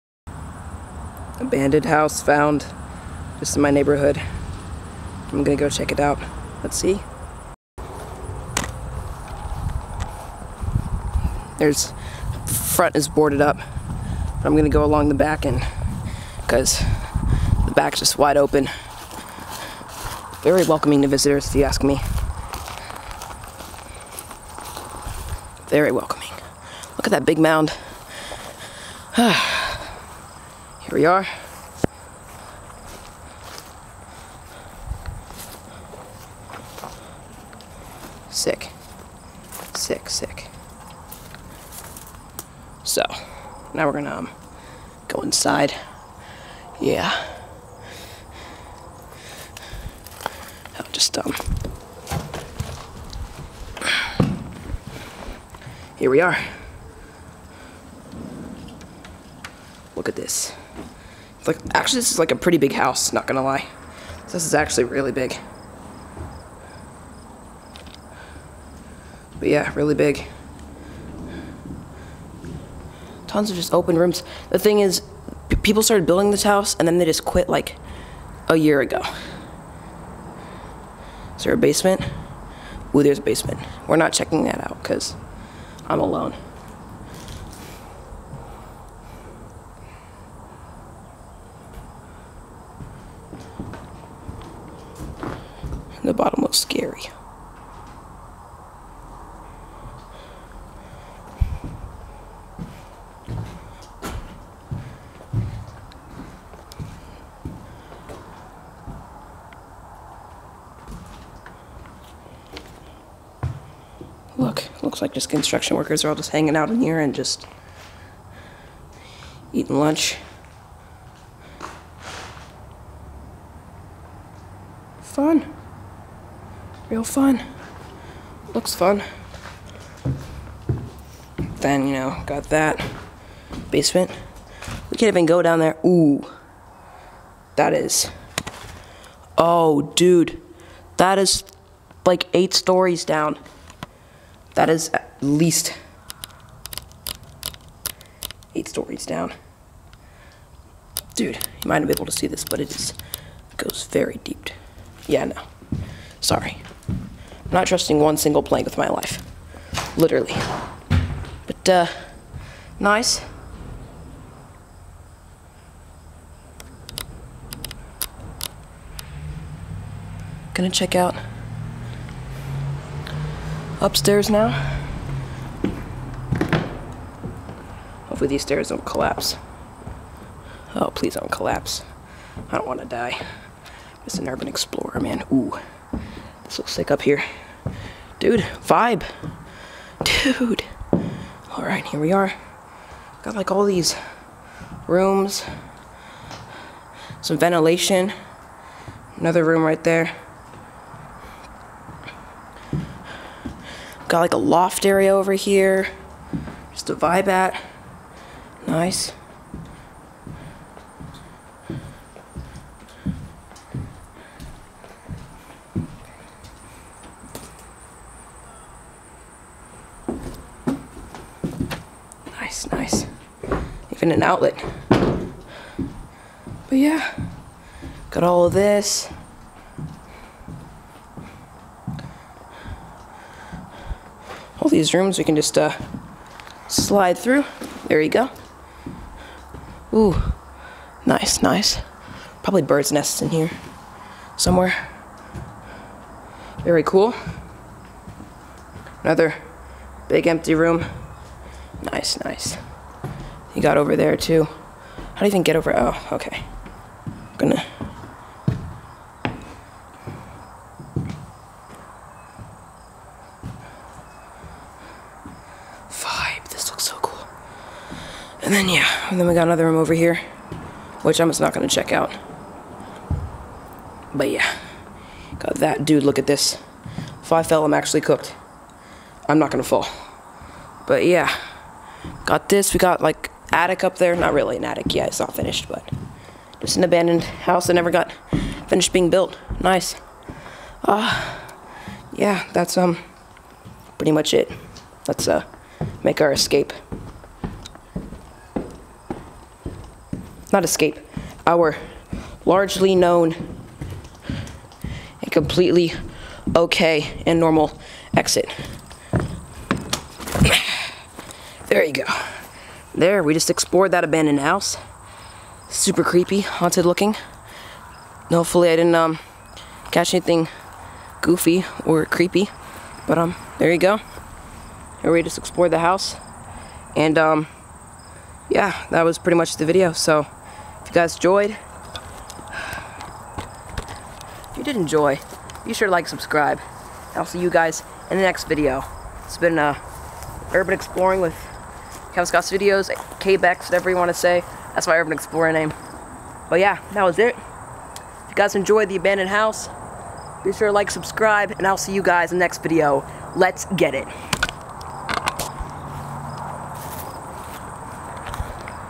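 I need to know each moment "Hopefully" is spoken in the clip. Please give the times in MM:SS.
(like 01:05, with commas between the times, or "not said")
02:58, 05:18.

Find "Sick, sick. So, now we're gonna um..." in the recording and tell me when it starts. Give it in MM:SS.
00:39.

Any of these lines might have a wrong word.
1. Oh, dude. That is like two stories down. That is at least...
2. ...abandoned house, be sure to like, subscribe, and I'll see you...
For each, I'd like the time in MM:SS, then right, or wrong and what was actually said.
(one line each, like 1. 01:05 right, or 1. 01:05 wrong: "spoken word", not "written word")
1. 02:19 wrong: "eight", not "two"
2. 05:48 right.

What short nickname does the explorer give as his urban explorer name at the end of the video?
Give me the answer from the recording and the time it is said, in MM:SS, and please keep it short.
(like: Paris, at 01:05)
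KBEX, at 05:43.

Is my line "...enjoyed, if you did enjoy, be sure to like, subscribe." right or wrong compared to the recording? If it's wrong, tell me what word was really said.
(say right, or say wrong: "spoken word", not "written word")
right.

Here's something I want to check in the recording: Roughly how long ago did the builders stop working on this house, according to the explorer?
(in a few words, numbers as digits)
A year ago.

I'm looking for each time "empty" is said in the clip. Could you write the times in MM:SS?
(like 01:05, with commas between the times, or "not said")
04:10.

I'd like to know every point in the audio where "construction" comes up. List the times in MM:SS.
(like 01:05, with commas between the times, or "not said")
01:55.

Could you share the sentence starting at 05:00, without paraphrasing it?
Not escape, our largely known and completely okay and normal exit.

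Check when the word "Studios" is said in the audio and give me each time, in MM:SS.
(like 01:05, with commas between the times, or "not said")
05:42.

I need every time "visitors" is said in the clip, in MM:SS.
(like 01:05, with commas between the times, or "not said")
00:21.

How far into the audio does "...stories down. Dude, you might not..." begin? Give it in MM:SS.
02:28.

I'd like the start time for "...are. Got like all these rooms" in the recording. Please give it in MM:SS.
03:12.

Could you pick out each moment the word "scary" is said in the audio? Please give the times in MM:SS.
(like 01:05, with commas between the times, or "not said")
01:36.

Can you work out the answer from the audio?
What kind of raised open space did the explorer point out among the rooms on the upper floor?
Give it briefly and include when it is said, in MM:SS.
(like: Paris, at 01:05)
Loft area, at 03:24.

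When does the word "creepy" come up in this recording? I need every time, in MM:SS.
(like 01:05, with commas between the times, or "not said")
05:16, 05:22.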